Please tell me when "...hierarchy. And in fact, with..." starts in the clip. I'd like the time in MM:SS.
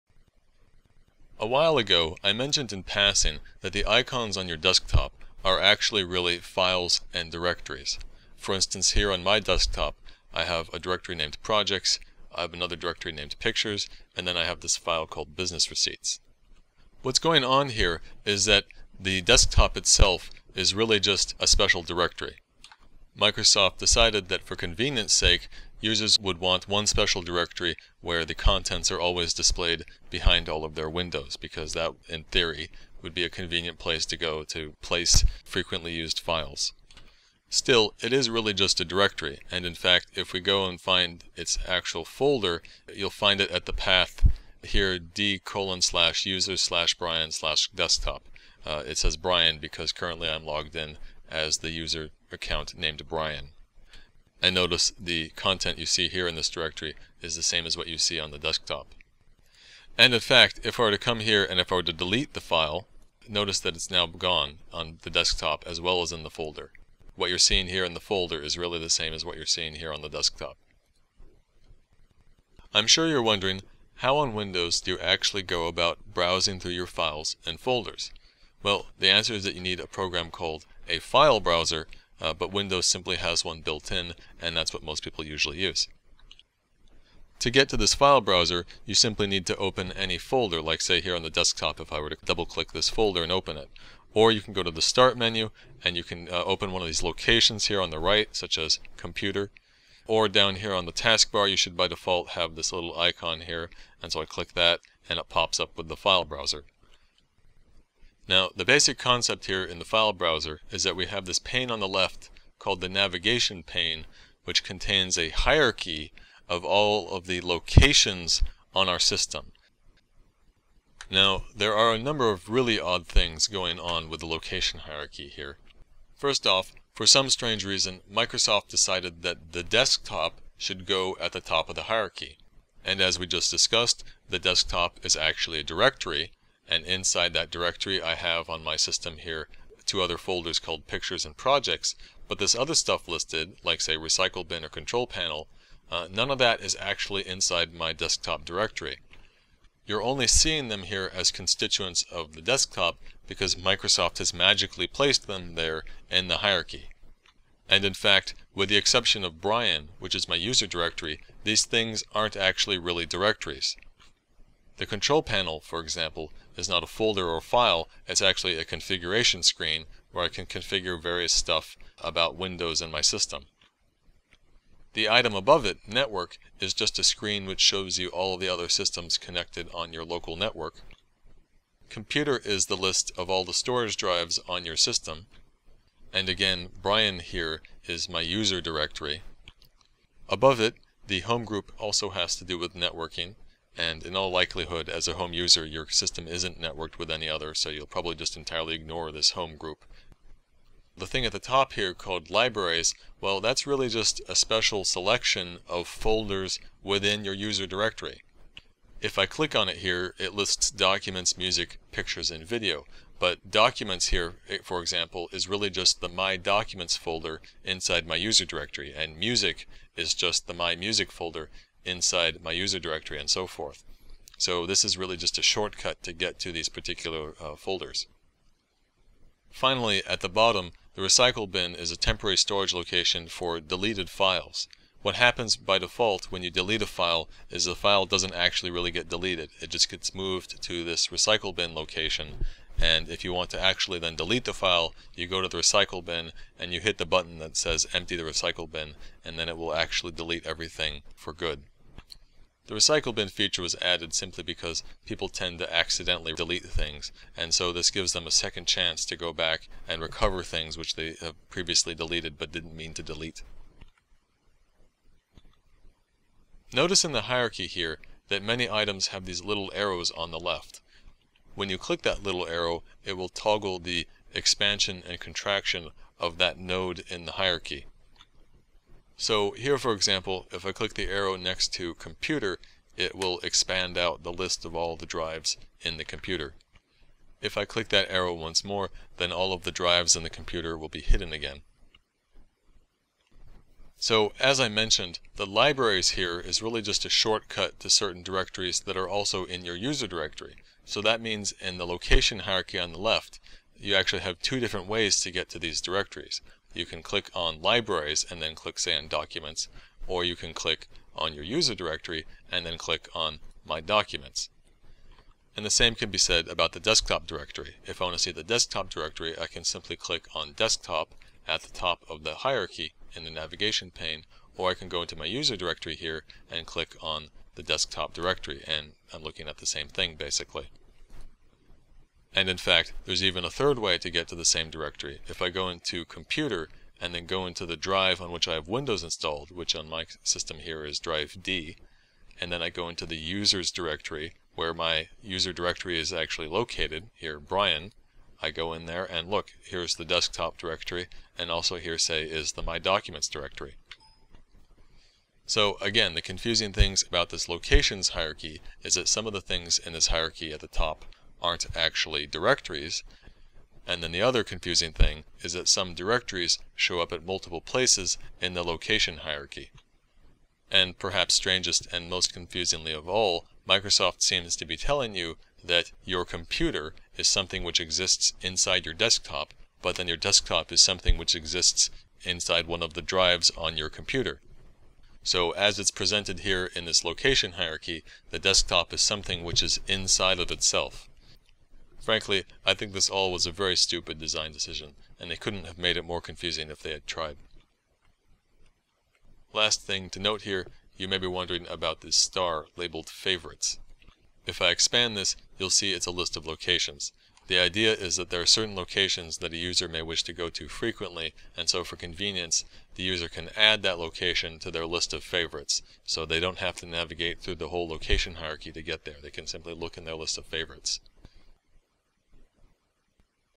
02:36.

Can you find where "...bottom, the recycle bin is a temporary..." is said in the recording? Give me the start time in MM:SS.
03:50.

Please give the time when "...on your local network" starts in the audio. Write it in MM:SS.
02:59.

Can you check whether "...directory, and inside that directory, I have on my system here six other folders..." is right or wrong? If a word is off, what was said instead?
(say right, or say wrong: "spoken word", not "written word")
wrong: "two", not "six".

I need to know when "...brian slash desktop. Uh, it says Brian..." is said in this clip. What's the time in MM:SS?
00:46.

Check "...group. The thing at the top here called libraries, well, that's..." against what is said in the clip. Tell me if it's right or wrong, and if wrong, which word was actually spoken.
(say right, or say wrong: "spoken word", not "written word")
right.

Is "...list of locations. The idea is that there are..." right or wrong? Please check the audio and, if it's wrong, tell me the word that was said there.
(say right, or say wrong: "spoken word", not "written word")
right.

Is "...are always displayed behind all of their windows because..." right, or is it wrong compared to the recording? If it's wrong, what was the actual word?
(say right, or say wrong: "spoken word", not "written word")
right.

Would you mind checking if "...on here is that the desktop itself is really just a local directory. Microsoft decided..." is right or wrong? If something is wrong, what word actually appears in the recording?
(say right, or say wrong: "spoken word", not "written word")
wrong: "special", not "local".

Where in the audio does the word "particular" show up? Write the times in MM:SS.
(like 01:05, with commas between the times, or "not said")
03:46.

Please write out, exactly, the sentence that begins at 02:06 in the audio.
First off, for some strange reason, Microsoft decided that the desktop should go at the top of the hierarchy.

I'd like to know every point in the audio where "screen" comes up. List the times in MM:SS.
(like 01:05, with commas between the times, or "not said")
02:49, 02:57.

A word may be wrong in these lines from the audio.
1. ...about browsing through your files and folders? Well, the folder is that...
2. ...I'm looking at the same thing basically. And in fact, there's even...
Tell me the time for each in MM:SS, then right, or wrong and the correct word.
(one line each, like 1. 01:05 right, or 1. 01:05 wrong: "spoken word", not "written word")
1. 01:15 wrong: "answer", not "folder"
2. 05:29 right.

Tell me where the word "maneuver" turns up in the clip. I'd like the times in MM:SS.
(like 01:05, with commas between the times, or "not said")
not said.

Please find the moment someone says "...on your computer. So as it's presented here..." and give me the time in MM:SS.
06:23.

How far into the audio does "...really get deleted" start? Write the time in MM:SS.
03:58.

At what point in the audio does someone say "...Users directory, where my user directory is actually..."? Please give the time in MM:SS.
05:43.